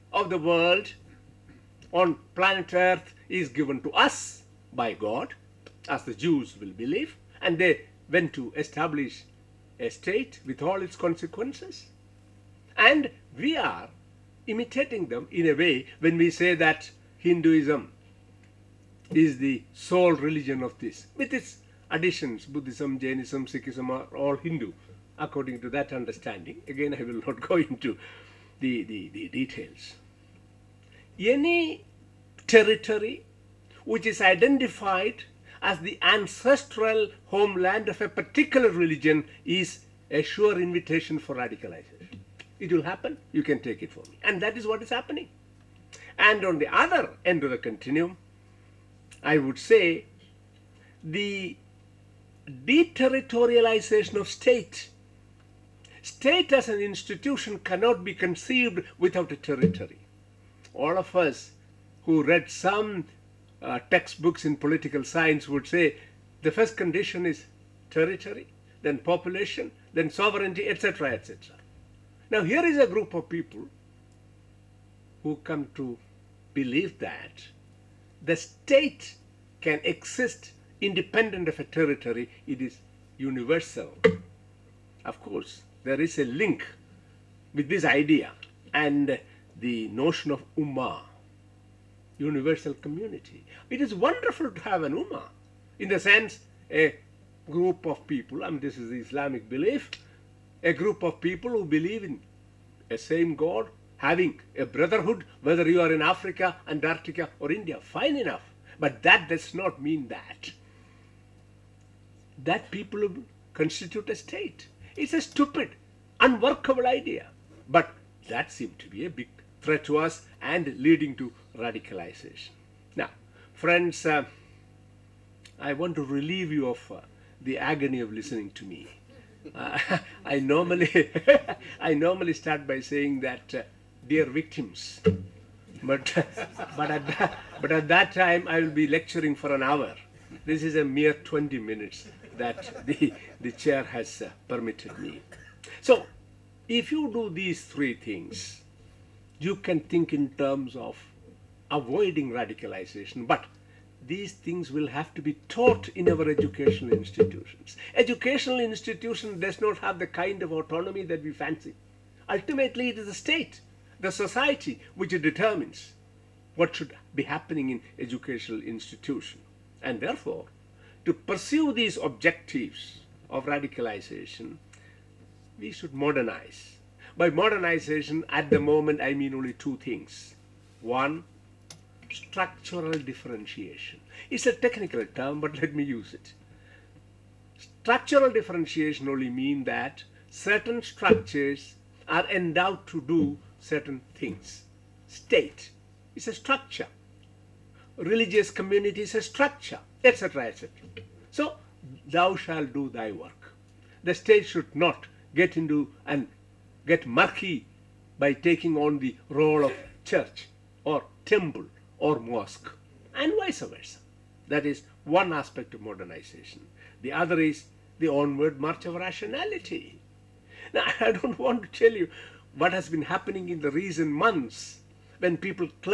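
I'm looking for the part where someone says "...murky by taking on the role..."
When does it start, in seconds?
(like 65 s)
207 s.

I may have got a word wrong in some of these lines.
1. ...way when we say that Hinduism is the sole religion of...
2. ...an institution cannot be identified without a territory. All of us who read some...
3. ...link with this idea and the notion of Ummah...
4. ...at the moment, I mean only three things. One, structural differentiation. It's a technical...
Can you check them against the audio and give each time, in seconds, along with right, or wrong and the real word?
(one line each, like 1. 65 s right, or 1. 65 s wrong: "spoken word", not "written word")
1. 15 s right
2. 56 s wrong: "conceived", not "identified"
3. 86 s right
4. 178 s wrong: "two", not "three".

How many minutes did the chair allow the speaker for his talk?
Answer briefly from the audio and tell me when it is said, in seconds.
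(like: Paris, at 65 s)
20, at 141 s.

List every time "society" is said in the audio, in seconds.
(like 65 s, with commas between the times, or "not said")
164 s.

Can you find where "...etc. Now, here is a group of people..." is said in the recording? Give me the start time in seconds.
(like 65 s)
71 s.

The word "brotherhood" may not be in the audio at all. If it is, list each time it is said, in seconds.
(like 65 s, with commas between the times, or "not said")
104 s.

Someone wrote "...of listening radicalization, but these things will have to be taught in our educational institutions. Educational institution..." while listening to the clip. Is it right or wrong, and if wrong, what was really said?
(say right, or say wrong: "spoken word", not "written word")
wrong: "avoiding", not "listening".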